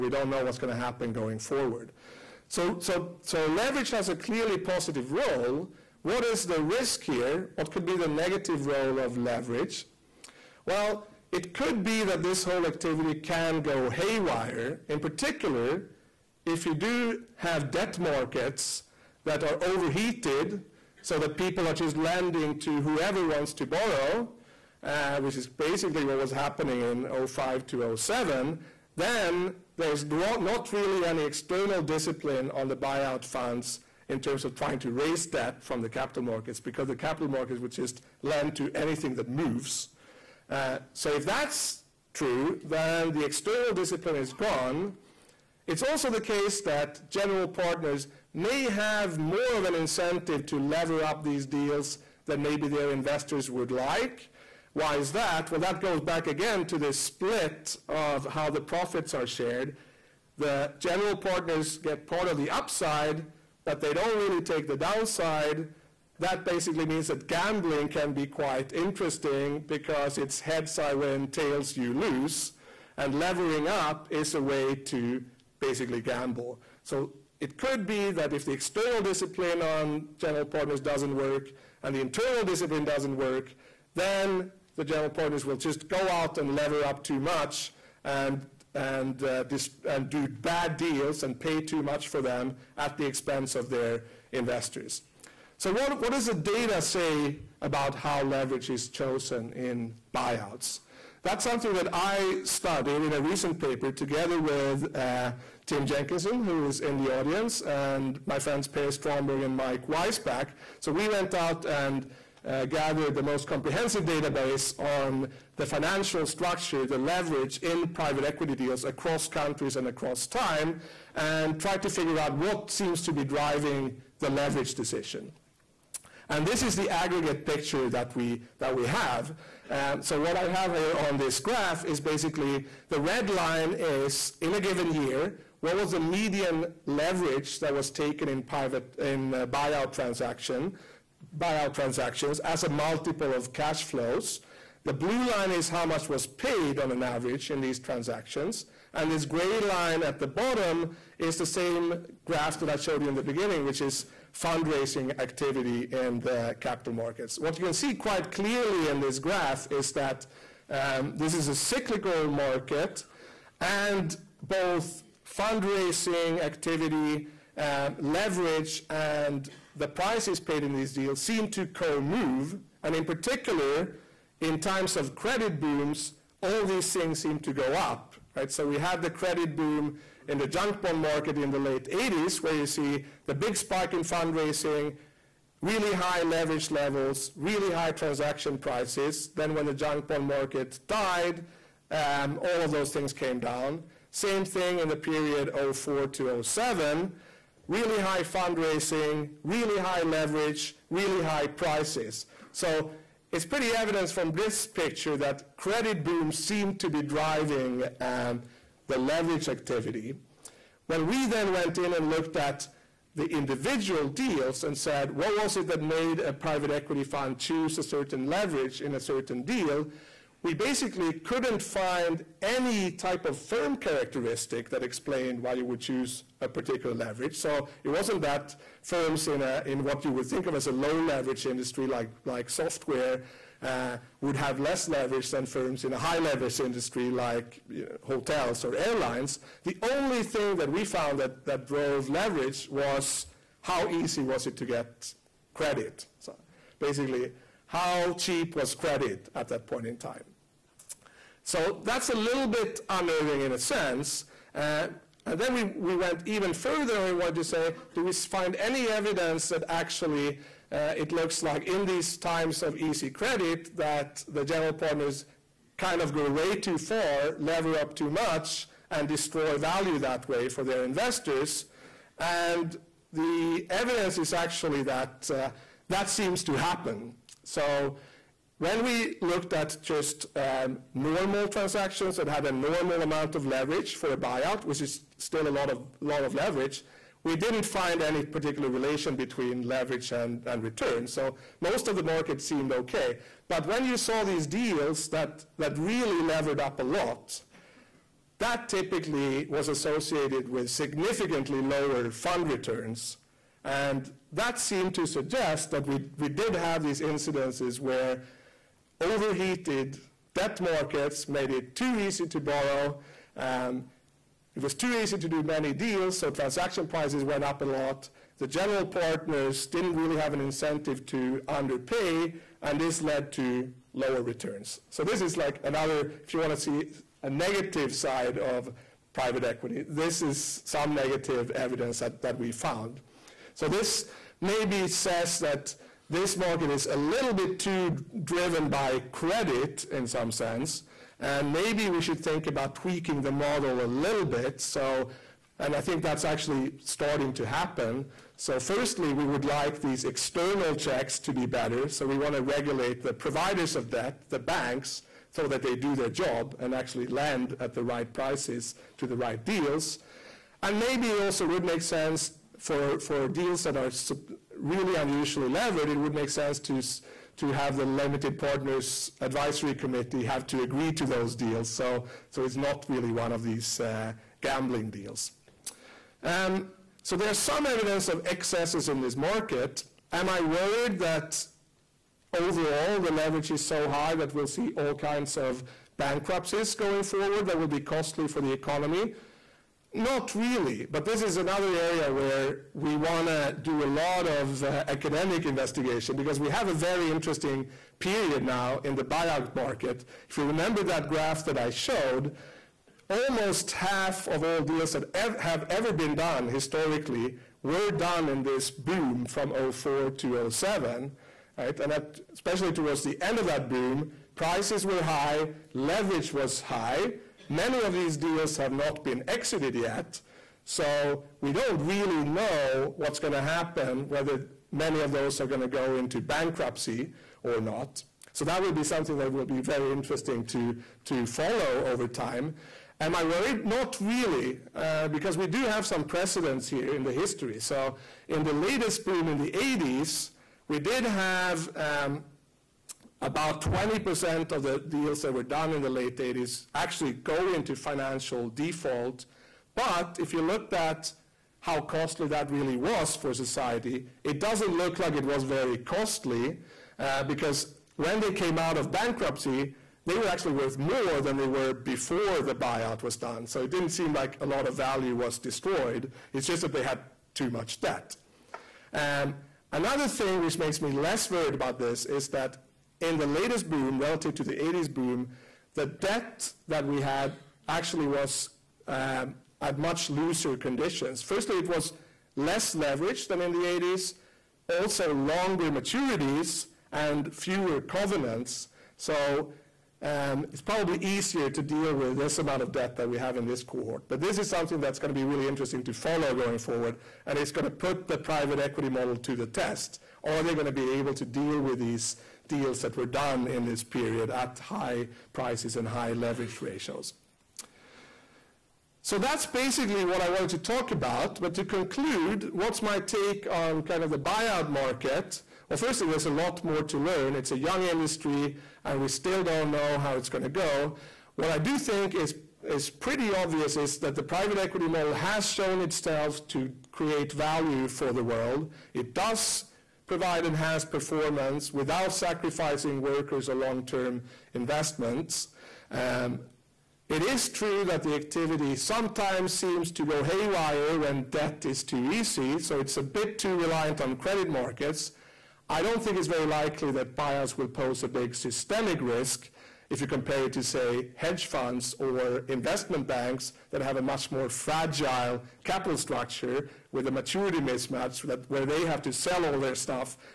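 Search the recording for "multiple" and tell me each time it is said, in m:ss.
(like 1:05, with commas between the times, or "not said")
2:22.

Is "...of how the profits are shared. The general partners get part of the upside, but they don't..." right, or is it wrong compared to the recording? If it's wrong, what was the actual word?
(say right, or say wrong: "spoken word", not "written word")
right.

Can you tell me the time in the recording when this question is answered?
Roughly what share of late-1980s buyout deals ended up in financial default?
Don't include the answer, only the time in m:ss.
7:23.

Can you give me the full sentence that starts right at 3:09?
Then when the junk bond market died, um, all of those things came down.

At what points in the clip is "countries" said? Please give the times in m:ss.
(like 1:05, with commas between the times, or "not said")
1:59.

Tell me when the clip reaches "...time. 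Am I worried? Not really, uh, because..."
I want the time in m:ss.
7:12.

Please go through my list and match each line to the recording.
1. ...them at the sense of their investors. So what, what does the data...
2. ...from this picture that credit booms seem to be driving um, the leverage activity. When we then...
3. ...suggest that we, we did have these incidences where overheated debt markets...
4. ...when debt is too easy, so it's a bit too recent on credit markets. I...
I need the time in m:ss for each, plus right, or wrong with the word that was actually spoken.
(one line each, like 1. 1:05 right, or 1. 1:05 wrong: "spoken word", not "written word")
1. 1:32 wrong: "expense", not "sense"
2. 3:24 right
3. 5:05 right
4. 9:00 wrong: "reliant", not "recent".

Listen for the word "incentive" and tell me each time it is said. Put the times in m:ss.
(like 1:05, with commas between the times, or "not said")
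0:49, 5:20.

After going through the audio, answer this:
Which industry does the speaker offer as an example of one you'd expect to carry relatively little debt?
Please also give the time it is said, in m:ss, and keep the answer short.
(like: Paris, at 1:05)
Software, at 3:52.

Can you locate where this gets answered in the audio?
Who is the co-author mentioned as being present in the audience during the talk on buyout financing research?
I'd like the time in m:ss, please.
1:45.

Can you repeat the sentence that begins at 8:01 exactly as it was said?
Firstly, it was less leverage than in the 80s, also longer maturities and fewer covenants.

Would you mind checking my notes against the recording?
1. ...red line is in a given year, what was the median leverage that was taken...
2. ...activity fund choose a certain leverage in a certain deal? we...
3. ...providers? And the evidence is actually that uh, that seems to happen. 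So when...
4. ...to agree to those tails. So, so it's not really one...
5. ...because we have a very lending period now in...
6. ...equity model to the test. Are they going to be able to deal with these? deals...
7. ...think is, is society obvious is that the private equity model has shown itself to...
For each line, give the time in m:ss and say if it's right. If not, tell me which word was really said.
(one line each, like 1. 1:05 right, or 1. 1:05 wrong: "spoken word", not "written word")
1. 2:12 right
2. 3:36 wrong: "equity", not "activity"
3. 4:30 wrong: "investors", not "providers"
4. 6:10 wrong: "deals", not "tails"
5. 6:36 wrong: "interesting", not "lending"
6. 8:18 right
7. 8:41 wrong: "pretty", not "society".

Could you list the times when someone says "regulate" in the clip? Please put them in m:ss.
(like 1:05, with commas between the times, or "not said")
5:52.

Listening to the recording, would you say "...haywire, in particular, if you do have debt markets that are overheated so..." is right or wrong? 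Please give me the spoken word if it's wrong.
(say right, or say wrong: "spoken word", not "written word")
right.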